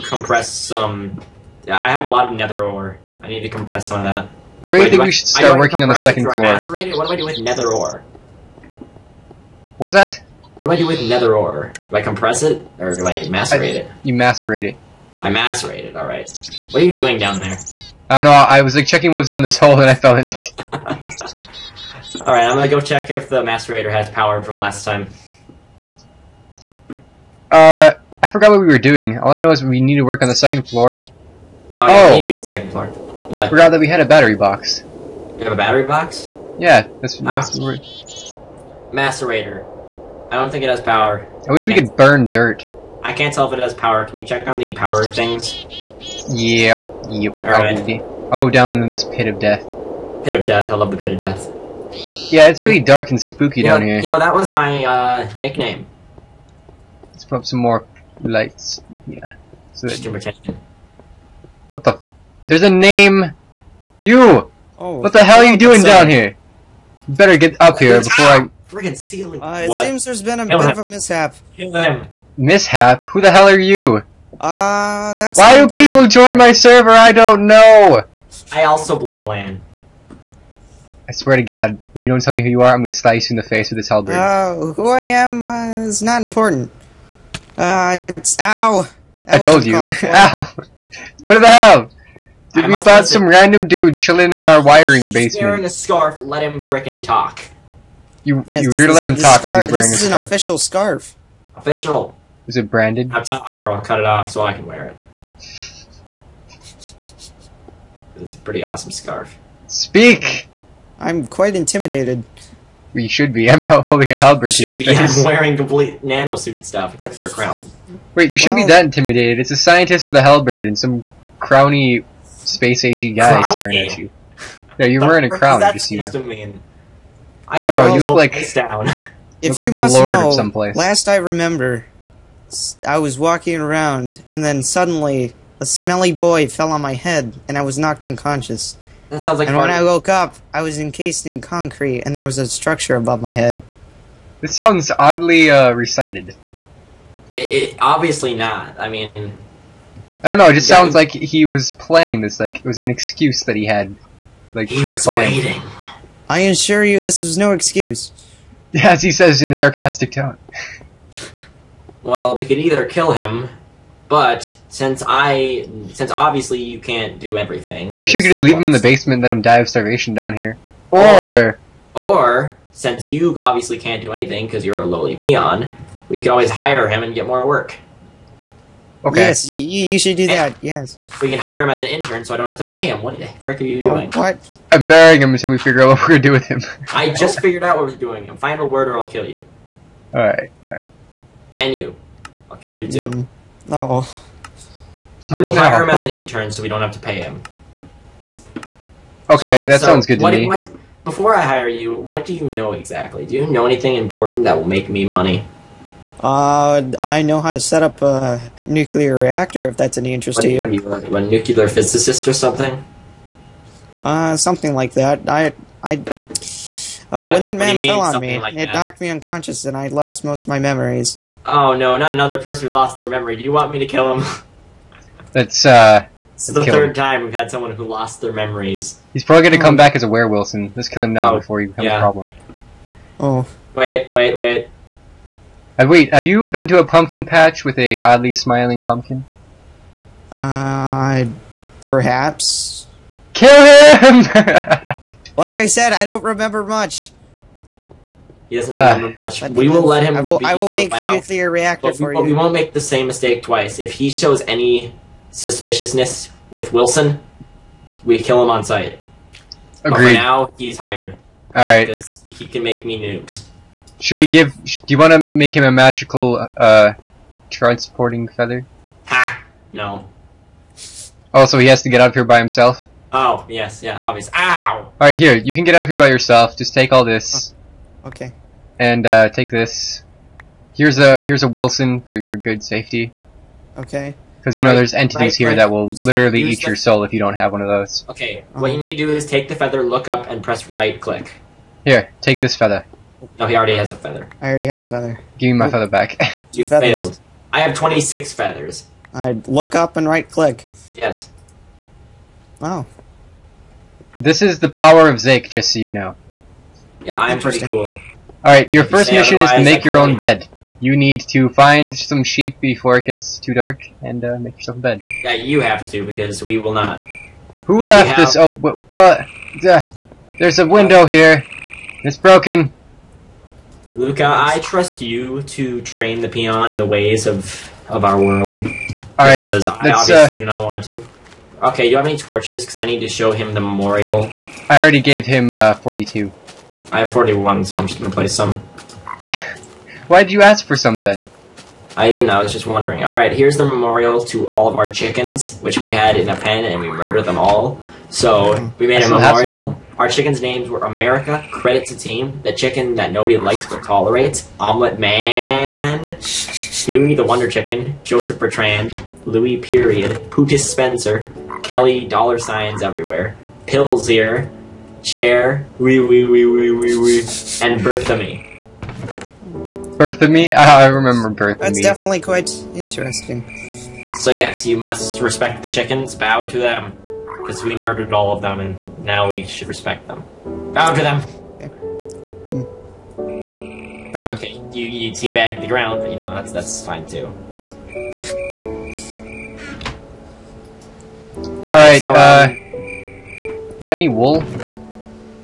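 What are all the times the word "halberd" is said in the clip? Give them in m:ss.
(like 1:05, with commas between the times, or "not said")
1:23, 1:54, 2:00.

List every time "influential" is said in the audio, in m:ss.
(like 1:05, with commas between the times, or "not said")
not said.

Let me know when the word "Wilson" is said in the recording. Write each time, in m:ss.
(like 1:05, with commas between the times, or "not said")
3:50, 4:16, 4:41.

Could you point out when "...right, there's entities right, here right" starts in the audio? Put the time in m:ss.
4:44.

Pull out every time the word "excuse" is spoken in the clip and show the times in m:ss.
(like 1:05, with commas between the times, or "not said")
2:32, 2:37.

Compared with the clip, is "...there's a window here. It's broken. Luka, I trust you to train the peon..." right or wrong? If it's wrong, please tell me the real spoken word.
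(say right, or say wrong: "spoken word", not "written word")
right.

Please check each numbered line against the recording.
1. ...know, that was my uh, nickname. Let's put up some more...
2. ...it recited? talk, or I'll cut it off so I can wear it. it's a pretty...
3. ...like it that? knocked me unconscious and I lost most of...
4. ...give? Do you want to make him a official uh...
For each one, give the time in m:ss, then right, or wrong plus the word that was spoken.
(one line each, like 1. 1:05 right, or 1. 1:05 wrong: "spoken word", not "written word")
1. 0:54 right
2. 1:42 wrong: "branded", not "recited"
3. 3:38 right
4. 4:24 wrong: "magical", not "official".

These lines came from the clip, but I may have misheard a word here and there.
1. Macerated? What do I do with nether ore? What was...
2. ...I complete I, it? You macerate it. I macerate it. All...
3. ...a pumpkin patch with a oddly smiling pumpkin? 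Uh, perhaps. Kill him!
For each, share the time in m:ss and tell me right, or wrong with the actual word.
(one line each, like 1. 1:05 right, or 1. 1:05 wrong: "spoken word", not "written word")
1. 0:06 right
2. 0:13 wrong: "macerate", not "complete"
3. 3:56 right.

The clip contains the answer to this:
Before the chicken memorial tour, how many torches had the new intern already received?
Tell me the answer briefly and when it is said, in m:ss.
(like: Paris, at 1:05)
42, at 5:35.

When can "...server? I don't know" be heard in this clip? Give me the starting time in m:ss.
1:16.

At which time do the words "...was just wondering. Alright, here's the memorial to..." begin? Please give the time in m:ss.
5:42.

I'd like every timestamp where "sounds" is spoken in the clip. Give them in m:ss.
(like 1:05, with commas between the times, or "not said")
2:19, 2:24, 2:30, 3:19.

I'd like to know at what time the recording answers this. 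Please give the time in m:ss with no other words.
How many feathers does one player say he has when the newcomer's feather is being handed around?
4:57.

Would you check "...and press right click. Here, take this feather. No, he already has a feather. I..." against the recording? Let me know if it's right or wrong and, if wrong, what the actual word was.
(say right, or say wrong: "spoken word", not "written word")
right.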